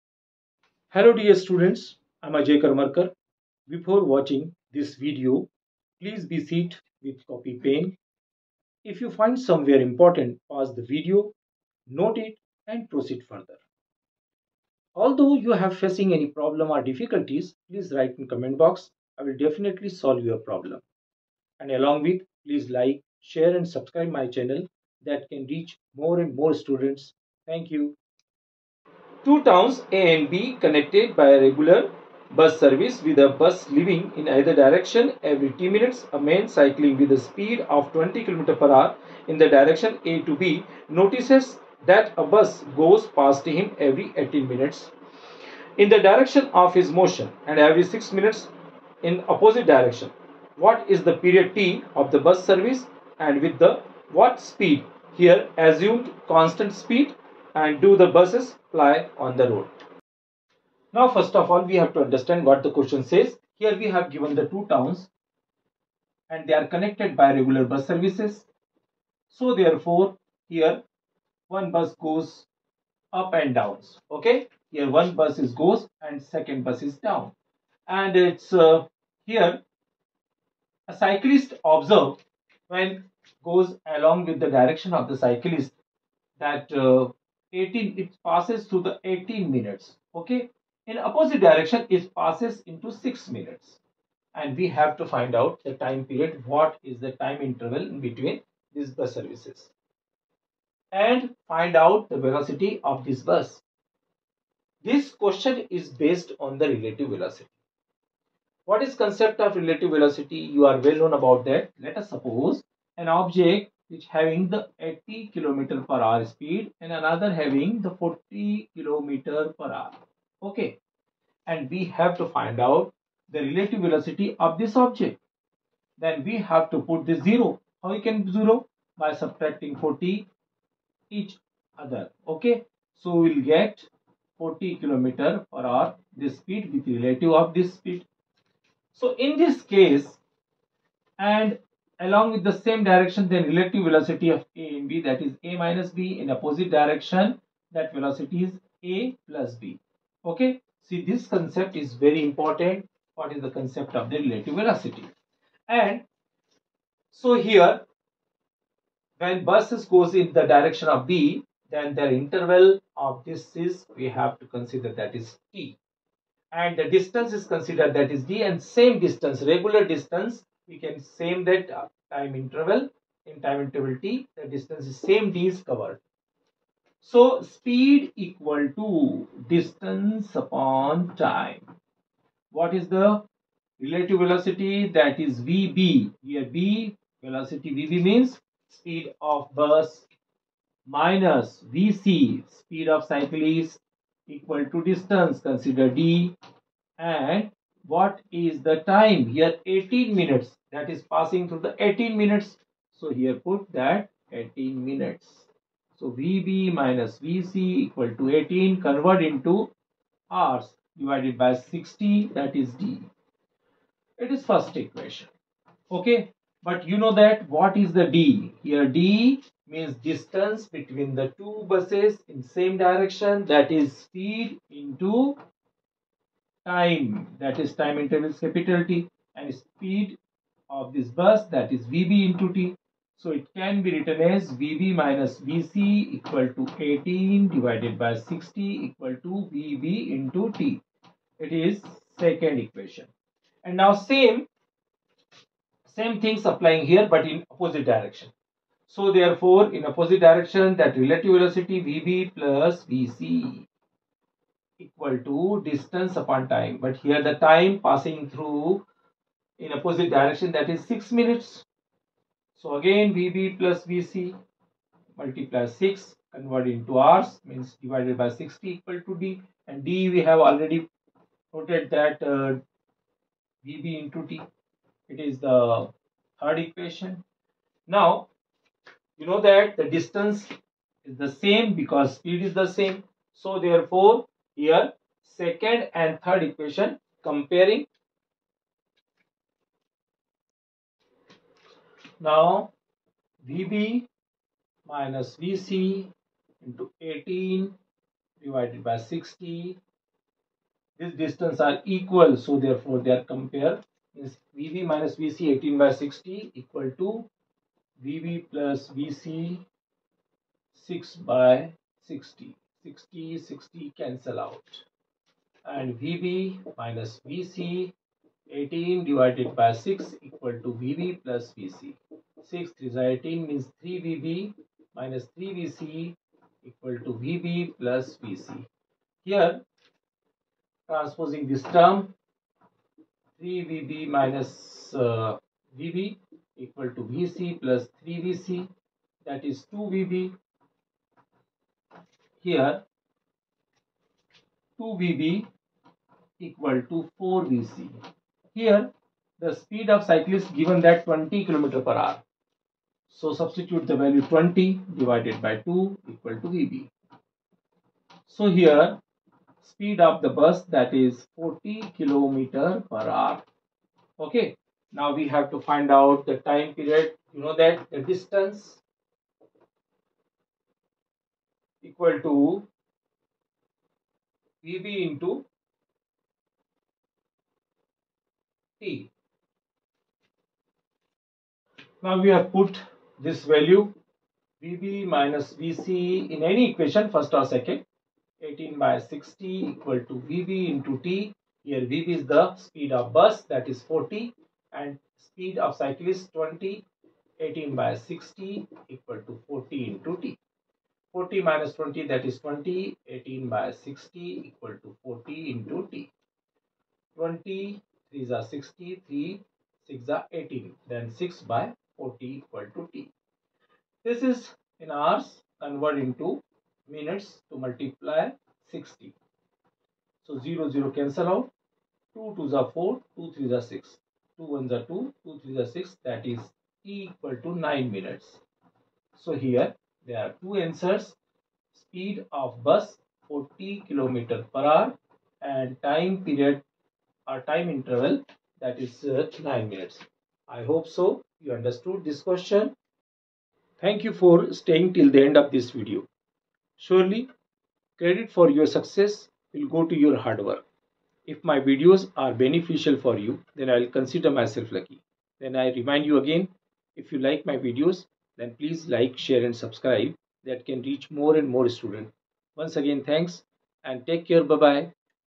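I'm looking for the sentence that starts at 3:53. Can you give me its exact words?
So it can be written as VB minus VC equal to 18 divided by 60 equal to VB into T.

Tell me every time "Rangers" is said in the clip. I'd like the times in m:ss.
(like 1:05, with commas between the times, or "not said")
not said.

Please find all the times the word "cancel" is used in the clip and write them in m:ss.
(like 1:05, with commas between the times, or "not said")
5:13, 7:00.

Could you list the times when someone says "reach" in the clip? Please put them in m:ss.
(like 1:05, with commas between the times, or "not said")
0:25, 7:40.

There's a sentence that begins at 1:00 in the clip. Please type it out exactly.
Now first of all we have to understand what the question says.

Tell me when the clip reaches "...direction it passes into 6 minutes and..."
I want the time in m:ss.
1:31.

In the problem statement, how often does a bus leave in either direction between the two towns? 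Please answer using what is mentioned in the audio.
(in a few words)
every 10 minutes.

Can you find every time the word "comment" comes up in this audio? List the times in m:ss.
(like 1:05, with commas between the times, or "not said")
0:18.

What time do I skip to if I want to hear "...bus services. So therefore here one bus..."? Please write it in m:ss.
1:07.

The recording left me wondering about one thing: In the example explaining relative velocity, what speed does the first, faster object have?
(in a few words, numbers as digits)
80 km per hour.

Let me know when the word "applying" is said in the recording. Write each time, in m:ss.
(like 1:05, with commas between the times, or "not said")
4:06.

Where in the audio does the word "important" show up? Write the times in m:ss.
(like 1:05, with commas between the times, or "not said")
0:09, 2:32.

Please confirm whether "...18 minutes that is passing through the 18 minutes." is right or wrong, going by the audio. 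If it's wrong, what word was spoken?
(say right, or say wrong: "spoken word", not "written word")
right.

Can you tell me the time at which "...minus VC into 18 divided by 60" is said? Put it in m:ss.
4:54.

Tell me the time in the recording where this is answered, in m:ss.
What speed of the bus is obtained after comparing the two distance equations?
6:01.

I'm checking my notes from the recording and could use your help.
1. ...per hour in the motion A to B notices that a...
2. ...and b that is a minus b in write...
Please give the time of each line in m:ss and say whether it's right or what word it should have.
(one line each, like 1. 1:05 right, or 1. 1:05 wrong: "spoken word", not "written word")
1. 0:38 wrong: "direction", not "motion"
2. 2:24 wrong: "opposite", not "write".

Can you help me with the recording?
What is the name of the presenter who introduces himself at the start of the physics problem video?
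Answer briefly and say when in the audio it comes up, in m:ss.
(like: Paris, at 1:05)
Ajay Karmarkar, at 0:02.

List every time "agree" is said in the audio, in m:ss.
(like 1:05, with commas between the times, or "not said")
not said.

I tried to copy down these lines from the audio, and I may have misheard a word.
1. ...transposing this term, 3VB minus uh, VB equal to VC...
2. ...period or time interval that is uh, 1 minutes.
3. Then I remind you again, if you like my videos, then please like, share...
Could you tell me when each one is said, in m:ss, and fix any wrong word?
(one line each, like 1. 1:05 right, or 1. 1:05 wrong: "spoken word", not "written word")
1. 5:30 right
2. 7:16 wrong: "9", not "1"
3. 7:35 right.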